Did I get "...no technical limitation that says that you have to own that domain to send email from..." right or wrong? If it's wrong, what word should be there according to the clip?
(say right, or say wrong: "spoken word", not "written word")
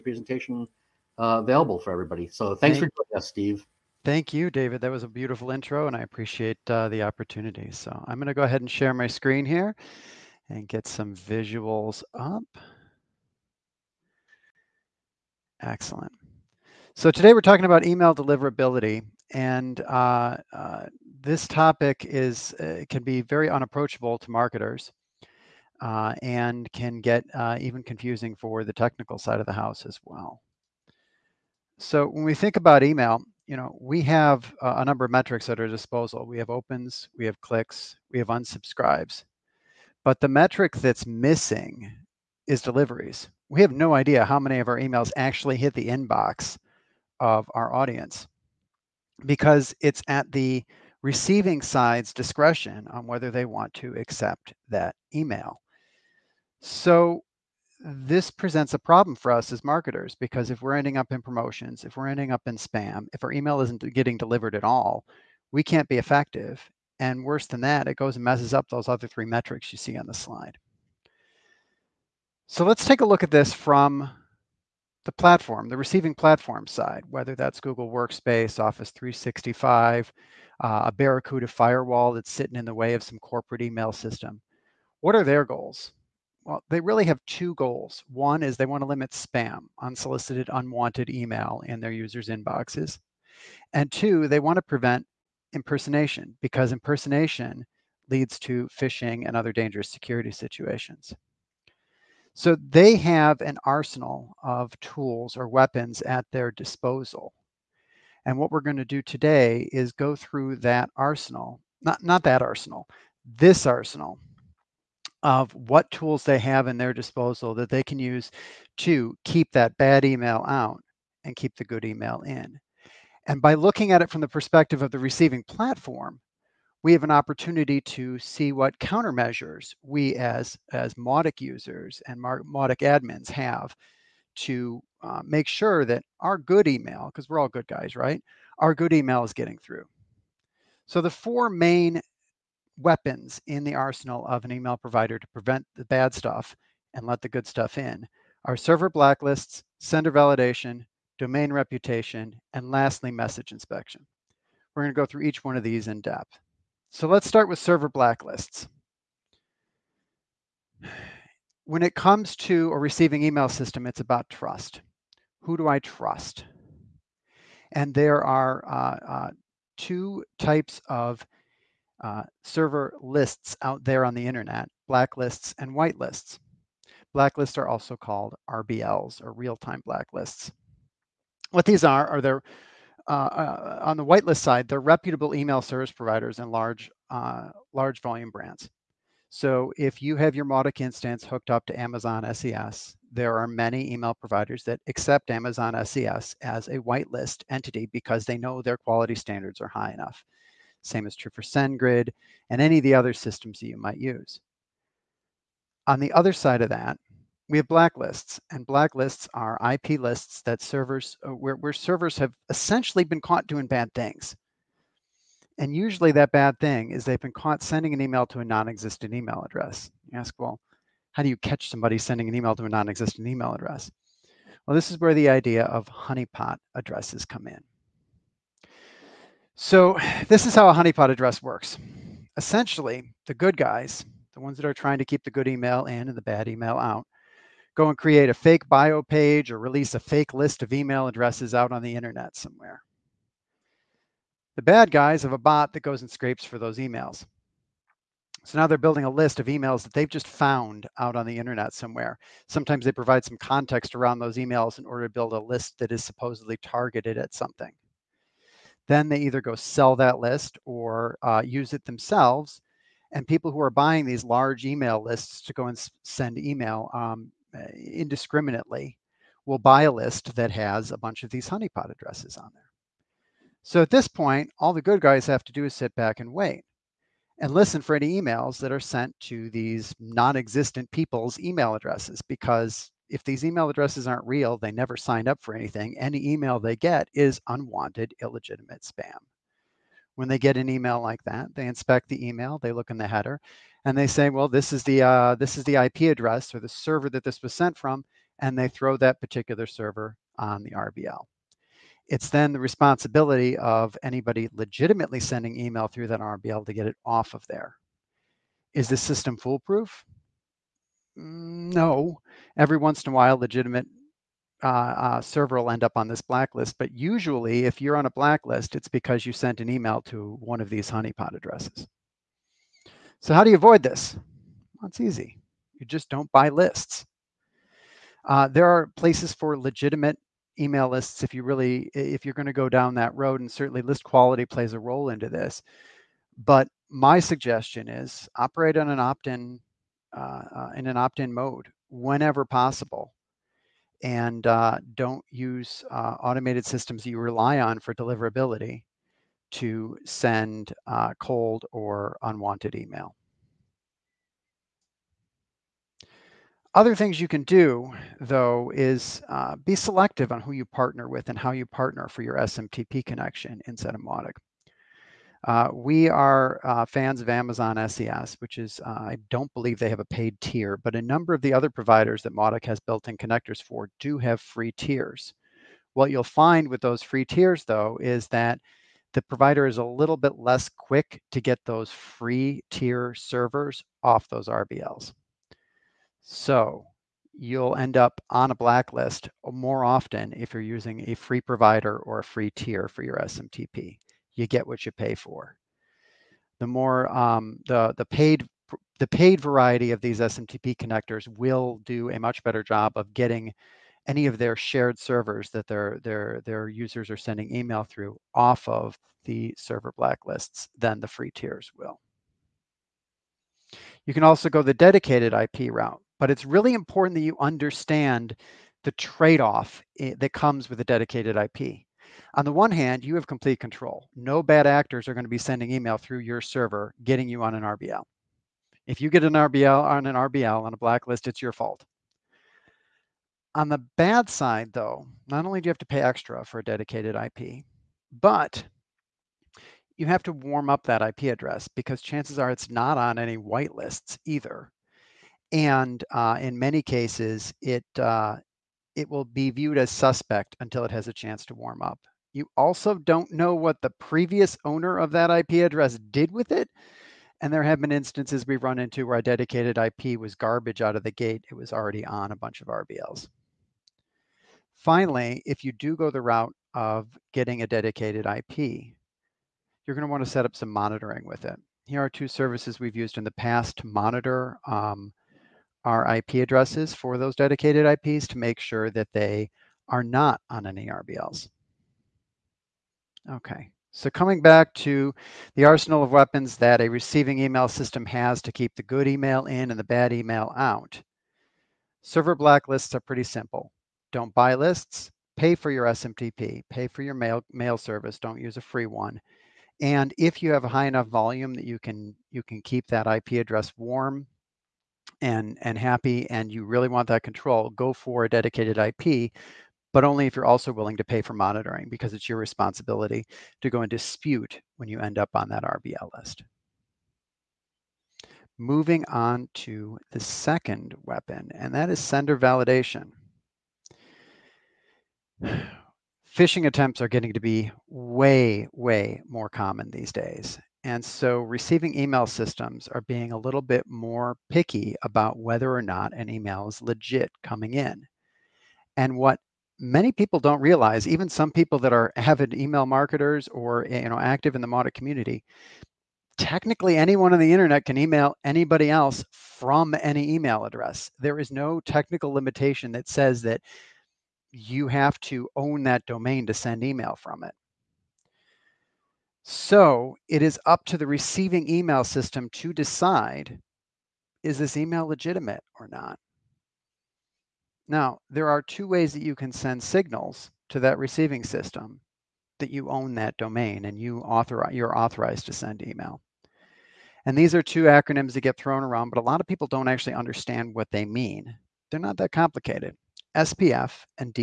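right.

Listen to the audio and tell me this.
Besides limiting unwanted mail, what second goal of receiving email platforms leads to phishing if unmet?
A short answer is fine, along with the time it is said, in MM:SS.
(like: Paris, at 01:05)
Prevent impersonation, at 01:34.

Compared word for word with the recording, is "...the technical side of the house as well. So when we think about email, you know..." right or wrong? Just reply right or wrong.
right.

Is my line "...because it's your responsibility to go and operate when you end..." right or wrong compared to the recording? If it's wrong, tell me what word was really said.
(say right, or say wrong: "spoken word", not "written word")
wrong: "dispute", not "operate".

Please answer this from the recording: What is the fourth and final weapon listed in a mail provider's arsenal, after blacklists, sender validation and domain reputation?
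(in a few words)
Message inspection.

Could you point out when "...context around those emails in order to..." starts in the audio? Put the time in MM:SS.
04:13.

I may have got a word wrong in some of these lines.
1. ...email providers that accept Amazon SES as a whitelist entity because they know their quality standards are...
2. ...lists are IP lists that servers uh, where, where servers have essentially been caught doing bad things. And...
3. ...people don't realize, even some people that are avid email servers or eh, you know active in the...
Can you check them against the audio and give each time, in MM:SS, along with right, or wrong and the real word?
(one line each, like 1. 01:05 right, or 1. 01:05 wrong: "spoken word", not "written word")
1. 03:13 right
2. 03:28 wrong: "blacklists", not "lists"
3. 09:00 wrong: "marketers", not "servers".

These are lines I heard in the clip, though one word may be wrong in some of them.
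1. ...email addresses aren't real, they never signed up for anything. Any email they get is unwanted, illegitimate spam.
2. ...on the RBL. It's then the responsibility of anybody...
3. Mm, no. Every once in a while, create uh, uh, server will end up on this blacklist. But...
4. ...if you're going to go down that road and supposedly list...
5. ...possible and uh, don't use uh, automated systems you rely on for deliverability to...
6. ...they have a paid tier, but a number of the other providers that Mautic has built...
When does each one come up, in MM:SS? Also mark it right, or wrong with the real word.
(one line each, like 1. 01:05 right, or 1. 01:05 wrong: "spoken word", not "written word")
1. 04:43 right
2. 05:00 right
3. 05:11 wrong: "legitimate", not "create"
4. 05:31 wrong: "certainly", not "supposedly"
5. 05:42 right
6. 06:09 right.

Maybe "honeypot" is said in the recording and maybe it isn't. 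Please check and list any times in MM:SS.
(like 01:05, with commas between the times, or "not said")
03:45, 03:50, 04:31, 05:20.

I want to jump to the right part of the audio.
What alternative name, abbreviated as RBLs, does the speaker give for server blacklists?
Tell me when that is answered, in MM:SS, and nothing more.
02:59.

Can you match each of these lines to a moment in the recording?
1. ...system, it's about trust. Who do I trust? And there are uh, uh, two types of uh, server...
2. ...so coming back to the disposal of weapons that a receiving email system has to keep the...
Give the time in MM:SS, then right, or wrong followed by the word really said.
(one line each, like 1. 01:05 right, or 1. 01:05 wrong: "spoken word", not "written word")
1. 02:43 right
2. 08:03 wrong: "arsenal", not "disposal".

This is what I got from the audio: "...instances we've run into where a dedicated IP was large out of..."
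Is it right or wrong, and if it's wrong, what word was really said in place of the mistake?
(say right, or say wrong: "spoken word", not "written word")
wrong: "garbage", not "large".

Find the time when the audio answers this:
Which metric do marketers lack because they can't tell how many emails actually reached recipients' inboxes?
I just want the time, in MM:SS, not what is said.
00:42.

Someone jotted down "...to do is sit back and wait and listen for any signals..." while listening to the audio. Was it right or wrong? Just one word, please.
wrong.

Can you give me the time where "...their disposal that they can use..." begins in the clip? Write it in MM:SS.
01:56.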